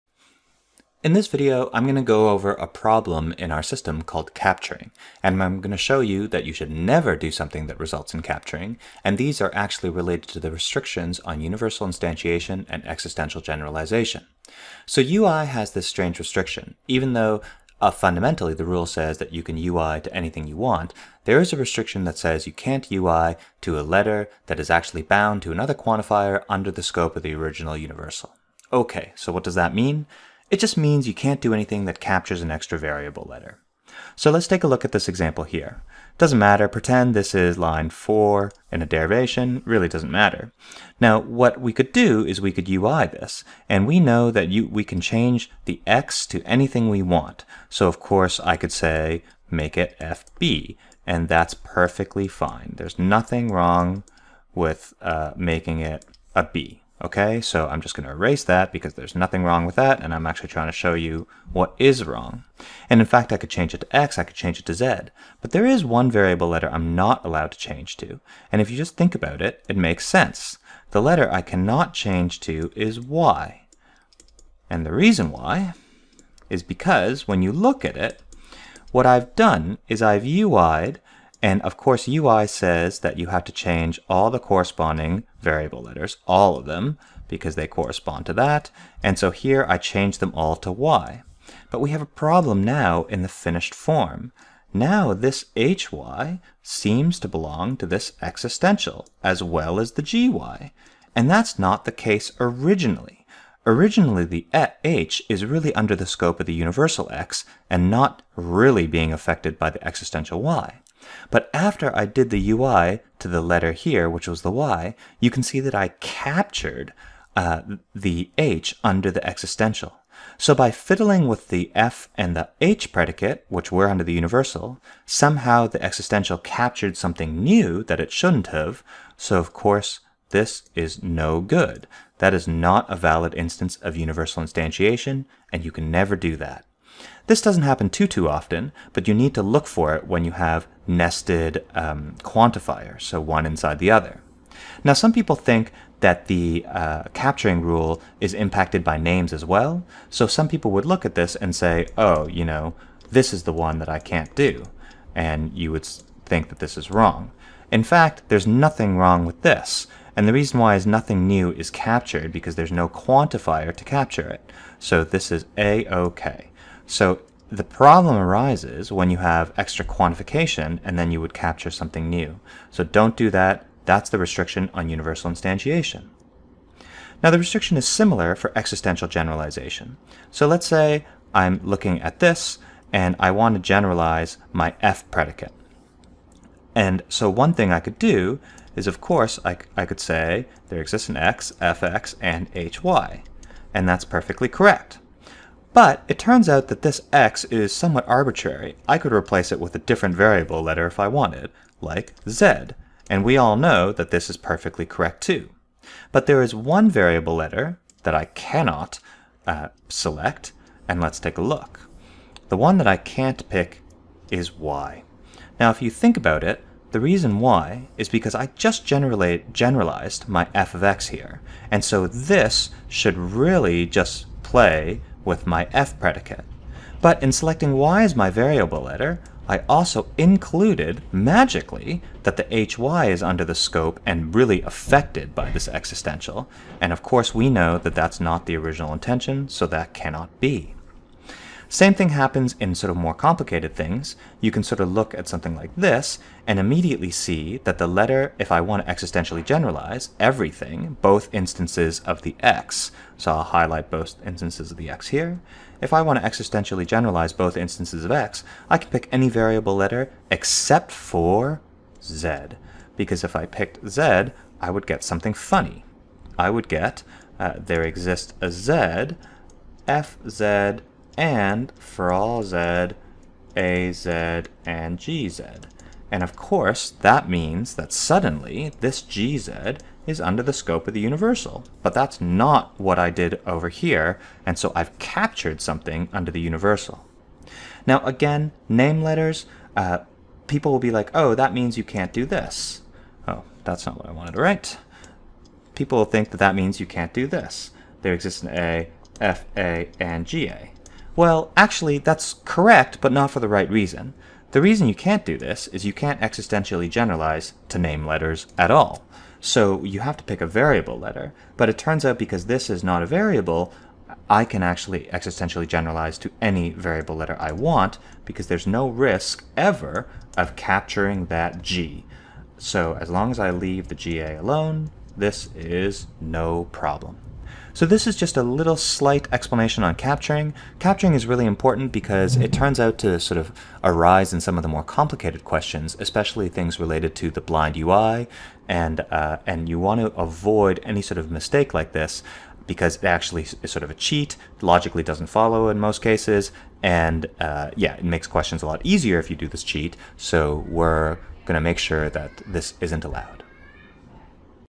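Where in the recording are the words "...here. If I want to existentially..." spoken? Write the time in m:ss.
4:15.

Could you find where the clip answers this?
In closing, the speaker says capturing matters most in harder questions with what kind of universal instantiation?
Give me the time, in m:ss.
5:37.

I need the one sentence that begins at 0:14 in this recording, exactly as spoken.
So UI has this strange restriction.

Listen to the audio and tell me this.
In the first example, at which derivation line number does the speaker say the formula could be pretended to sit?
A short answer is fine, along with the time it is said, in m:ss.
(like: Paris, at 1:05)
4, at 0:37.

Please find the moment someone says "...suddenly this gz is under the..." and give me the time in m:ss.
4:37.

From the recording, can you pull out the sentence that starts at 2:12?
That is not a valid instance of universal instantiation, and you can never do that.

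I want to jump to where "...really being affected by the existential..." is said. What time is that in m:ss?
1:48.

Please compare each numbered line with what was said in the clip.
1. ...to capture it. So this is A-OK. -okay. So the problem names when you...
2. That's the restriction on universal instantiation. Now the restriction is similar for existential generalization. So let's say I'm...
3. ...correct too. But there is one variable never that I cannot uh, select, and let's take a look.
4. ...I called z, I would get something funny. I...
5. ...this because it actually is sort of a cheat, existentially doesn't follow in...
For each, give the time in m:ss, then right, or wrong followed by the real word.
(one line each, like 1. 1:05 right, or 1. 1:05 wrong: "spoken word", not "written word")
1. 2:43 wrong: "arises", not "names"
2. 2:53 right
3. 3:24 wrong: "letter", not "never"
4. 4:23 wrong: "picked", not "called"
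5. 5:41 wrong: "logically", not "existentially".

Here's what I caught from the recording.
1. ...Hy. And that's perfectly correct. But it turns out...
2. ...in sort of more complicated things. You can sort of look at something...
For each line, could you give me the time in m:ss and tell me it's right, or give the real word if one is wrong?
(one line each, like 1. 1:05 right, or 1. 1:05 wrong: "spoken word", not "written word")
1. 3:12 right
2. 4:02 right.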